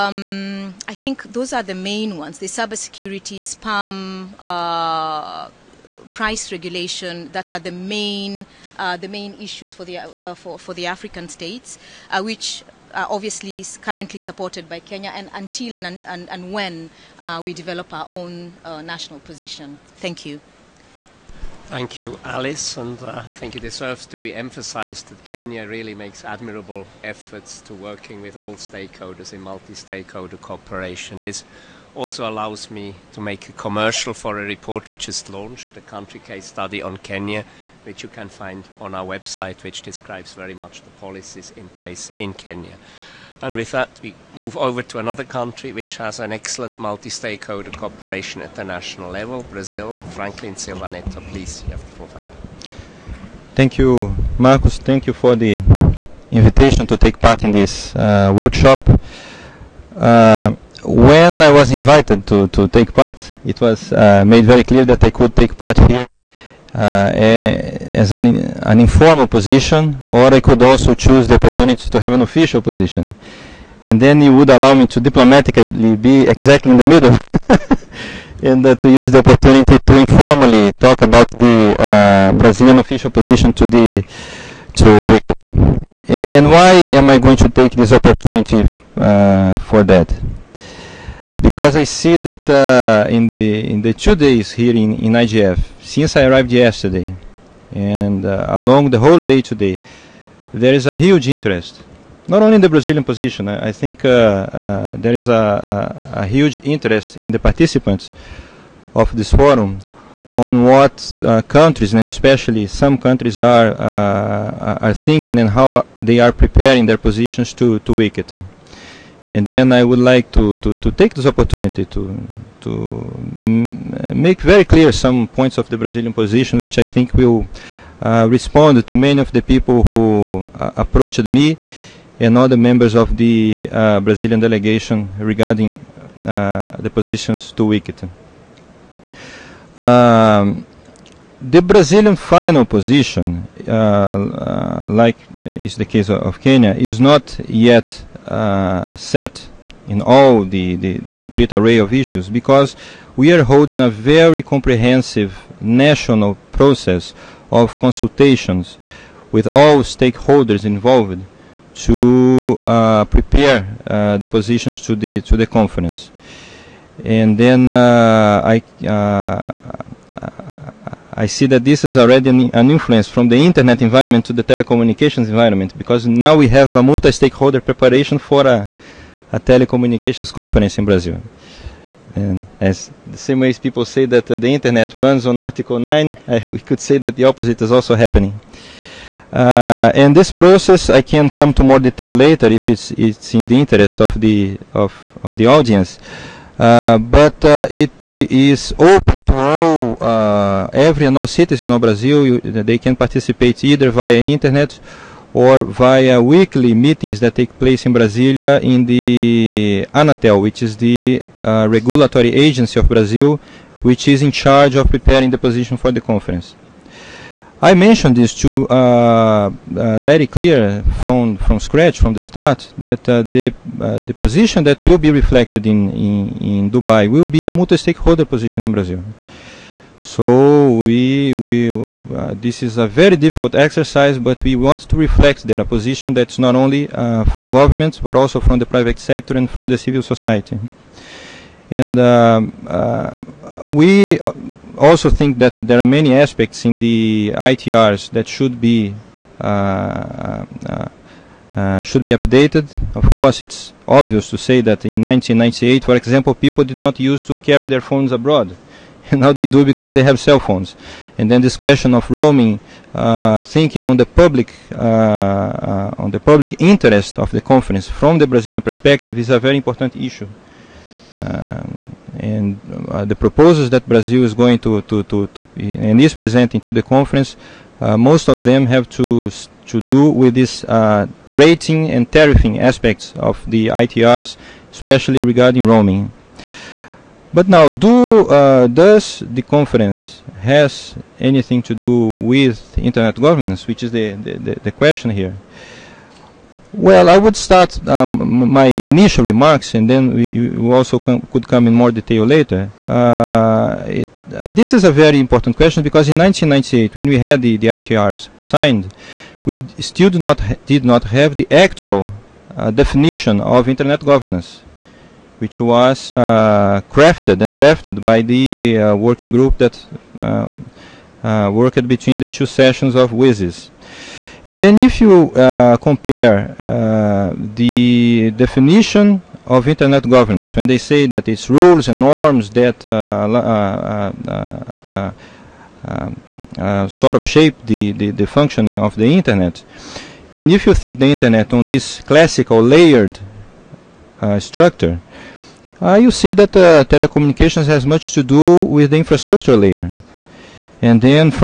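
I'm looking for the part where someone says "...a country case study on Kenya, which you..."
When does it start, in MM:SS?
00:35.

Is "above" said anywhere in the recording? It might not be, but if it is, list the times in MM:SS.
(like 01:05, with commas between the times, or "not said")
not said.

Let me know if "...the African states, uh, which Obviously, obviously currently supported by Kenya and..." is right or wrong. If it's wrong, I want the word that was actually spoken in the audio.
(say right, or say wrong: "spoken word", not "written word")
right.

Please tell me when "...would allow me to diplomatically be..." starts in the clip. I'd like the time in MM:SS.
01:14.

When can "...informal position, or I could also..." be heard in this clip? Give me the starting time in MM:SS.
01:08.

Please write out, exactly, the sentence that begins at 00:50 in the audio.
Franklin Silva Netto, please, you have the floor.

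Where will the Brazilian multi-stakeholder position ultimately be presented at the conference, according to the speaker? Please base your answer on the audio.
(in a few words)
Dubai.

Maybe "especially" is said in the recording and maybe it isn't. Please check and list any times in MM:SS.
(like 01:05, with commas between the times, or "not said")
01:52, 04:44.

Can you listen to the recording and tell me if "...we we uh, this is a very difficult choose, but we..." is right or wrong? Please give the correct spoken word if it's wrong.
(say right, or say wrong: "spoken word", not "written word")
wrong: "exercise", not "choose".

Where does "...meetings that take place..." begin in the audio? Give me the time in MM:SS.
03:26.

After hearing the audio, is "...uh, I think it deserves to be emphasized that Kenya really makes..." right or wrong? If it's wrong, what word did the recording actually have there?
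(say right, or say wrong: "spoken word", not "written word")
right.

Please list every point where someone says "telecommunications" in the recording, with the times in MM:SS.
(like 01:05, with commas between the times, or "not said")
02:54, 02:59, 05:46.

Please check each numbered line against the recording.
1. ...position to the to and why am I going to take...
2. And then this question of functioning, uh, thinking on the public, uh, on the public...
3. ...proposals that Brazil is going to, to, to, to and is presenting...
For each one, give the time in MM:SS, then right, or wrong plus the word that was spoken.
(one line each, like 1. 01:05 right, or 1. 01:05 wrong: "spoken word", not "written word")
1. 01:23 right
2. 04:21 wrong: "roaming", not "functioning"
3. 04:33 right.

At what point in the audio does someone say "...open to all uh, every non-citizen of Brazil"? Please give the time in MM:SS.
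03:18.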